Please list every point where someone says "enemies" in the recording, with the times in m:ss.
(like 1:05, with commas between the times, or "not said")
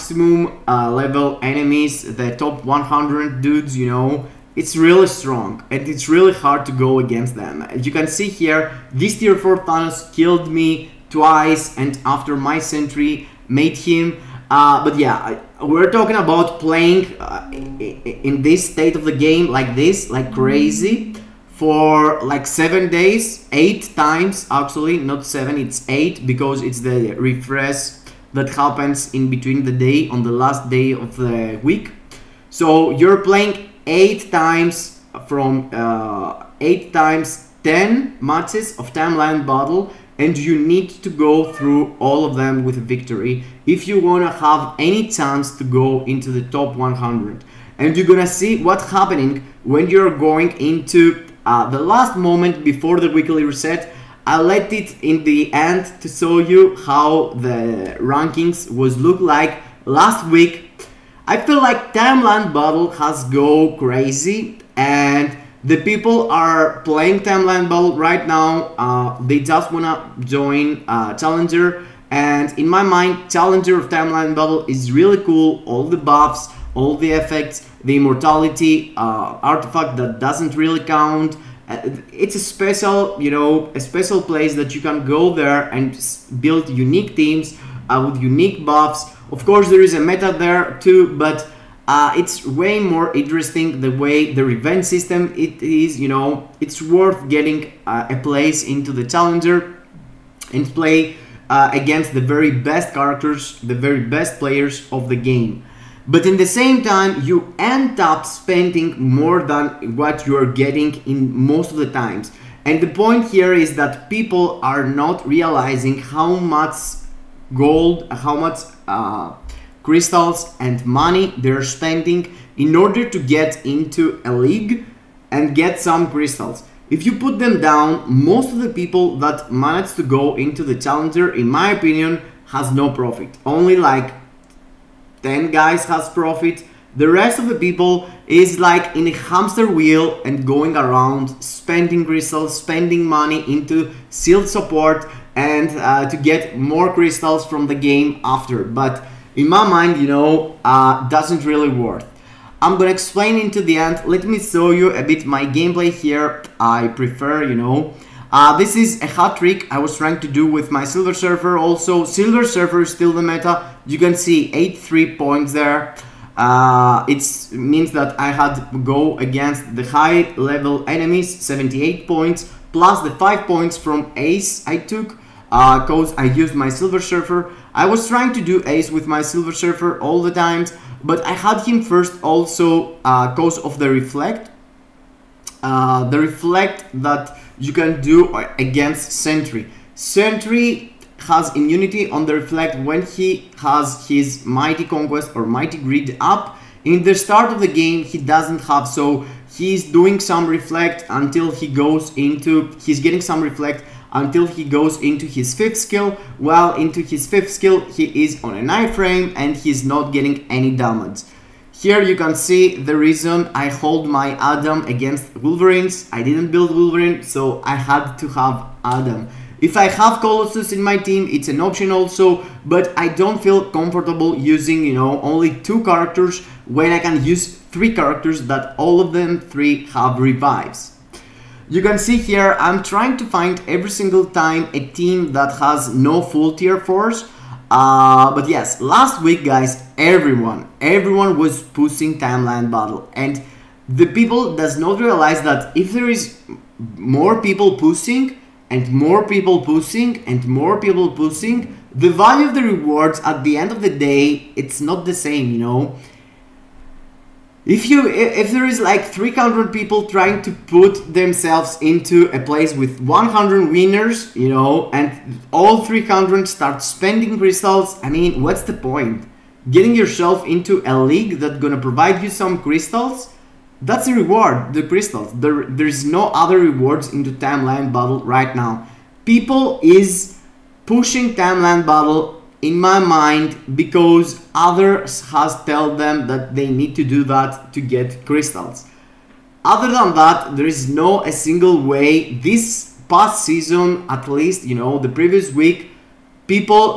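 0:01, 2:50.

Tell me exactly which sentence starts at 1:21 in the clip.
Uh, it's a special, you know, a special place that you can go there and build unique teams uh, with unique buffs.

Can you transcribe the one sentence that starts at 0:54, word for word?
I let it in the end to show you how the rankings was look like last week.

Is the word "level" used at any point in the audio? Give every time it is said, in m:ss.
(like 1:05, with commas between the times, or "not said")
0:00, 2:50.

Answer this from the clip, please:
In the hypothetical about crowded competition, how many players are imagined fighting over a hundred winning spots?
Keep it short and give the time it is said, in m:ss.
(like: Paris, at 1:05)
300, at 4:19.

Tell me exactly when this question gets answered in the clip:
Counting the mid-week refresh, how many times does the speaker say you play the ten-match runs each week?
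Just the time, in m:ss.
0:23.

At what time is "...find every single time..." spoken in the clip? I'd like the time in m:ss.
3:53.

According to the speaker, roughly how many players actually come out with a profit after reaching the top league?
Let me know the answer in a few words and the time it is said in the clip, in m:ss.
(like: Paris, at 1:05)
10, at 2:13.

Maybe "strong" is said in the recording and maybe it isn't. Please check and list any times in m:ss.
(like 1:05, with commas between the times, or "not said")
0:05.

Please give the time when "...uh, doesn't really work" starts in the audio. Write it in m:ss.
2:30.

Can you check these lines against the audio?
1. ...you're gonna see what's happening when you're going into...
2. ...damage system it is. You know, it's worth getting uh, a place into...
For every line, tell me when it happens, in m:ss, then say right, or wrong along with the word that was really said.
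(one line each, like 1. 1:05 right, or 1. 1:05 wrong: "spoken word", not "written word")
1. 0:47 right
2. 1:34 wrong: "revenge", not "damage".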